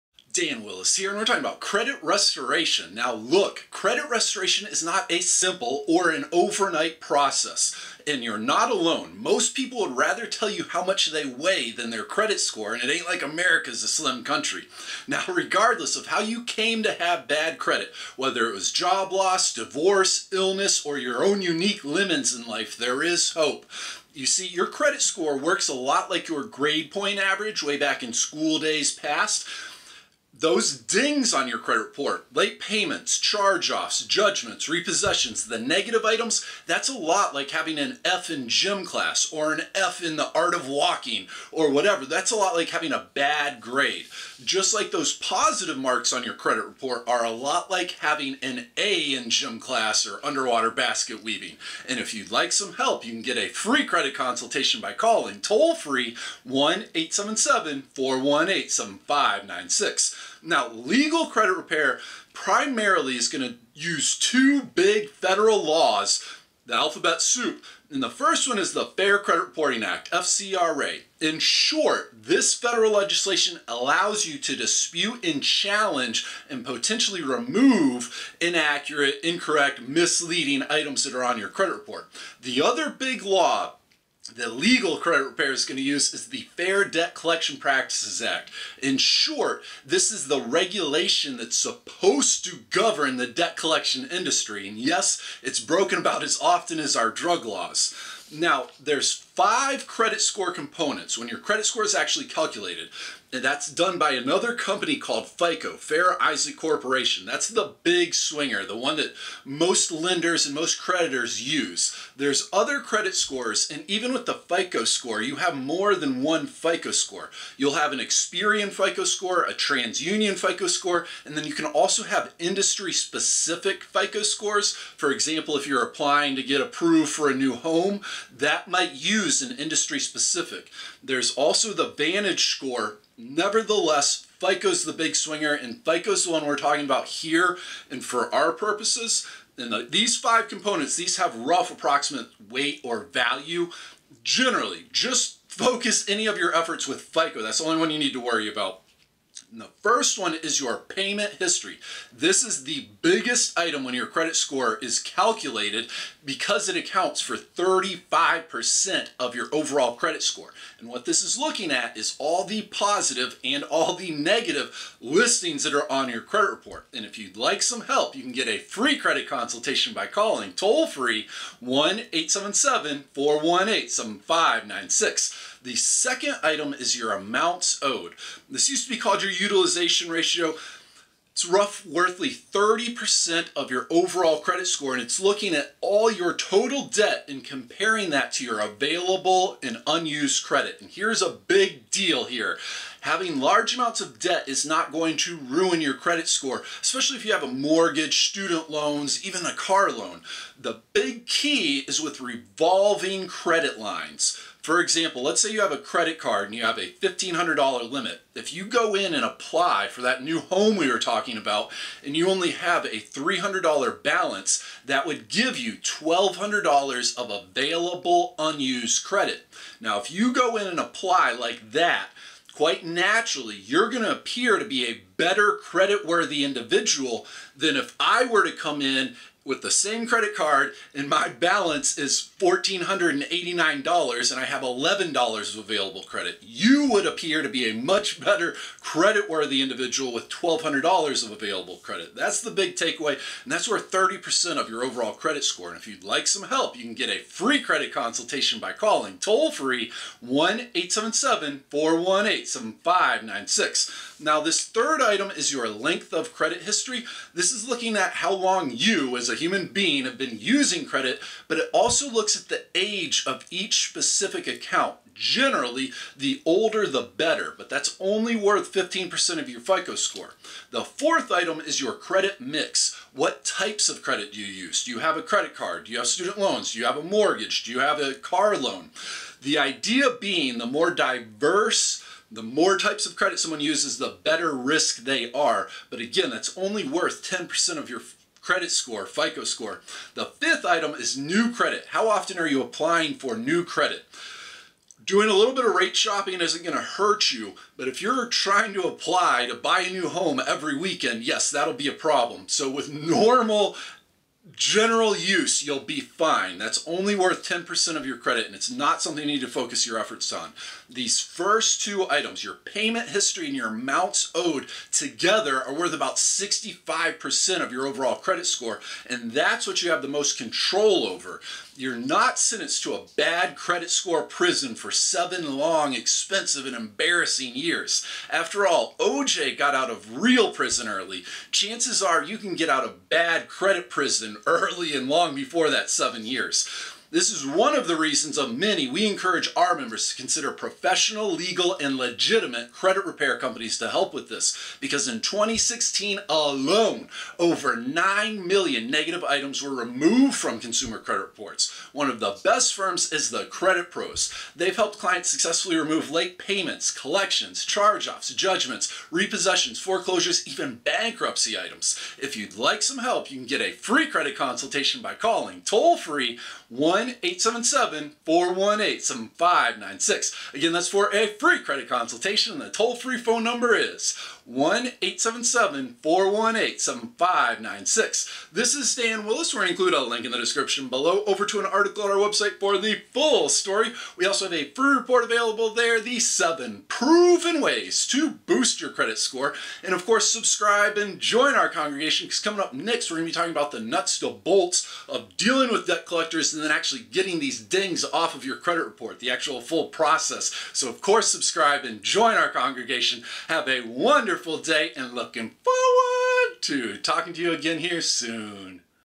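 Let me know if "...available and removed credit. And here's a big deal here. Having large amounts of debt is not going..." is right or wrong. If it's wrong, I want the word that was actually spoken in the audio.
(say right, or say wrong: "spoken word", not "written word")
wrong: "unused", not "removed".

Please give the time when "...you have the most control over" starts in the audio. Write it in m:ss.
5:19.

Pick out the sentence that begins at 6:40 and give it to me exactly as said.
So of course, subscribe and join our congregation.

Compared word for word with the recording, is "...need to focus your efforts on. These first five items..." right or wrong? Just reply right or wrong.
wrong.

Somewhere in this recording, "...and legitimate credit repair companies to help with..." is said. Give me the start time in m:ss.
5:41.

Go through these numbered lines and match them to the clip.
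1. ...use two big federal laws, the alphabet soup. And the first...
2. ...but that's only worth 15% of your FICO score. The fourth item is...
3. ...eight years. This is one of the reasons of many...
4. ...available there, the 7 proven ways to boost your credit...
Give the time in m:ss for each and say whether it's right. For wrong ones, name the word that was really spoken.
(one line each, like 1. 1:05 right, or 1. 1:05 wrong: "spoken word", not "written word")
1. 1:03 right
2. 4:27 right
3. 5:35 wrong: "seven", not "eight"
4. 6:25 right.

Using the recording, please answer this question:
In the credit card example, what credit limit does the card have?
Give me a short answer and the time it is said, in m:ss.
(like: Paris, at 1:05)
$1,500, at 3:26.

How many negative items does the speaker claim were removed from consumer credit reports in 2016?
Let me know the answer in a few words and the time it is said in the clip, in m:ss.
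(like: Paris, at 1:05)
9 million, at 5:47.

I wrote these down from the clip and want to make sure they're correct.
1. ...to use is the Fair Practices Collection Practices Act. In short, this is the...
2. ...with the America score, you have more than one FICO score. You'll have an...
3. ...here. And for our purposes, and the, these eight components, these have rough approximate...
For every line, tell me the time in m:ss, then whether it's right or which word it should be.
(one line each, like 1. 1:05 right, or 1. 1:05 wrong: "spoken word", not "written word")
1. 1:25 wrong: "Debt", not "Practices"
2. 1:54 wrong: "FICO", not "America"
3. 2:17 wrong: "five", not "eight".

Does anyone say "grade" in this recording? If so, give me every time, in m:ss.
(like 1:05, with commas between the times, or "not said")
0:26, 0:43.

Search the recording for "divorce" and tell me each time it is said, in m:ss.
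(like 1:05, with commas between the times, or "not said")
0:19.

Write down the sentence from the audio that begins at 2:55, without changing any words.
The second item is your amounts owed.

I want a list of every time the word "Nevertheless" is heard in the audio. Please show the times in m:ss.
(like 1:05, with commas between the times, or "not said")
2:13.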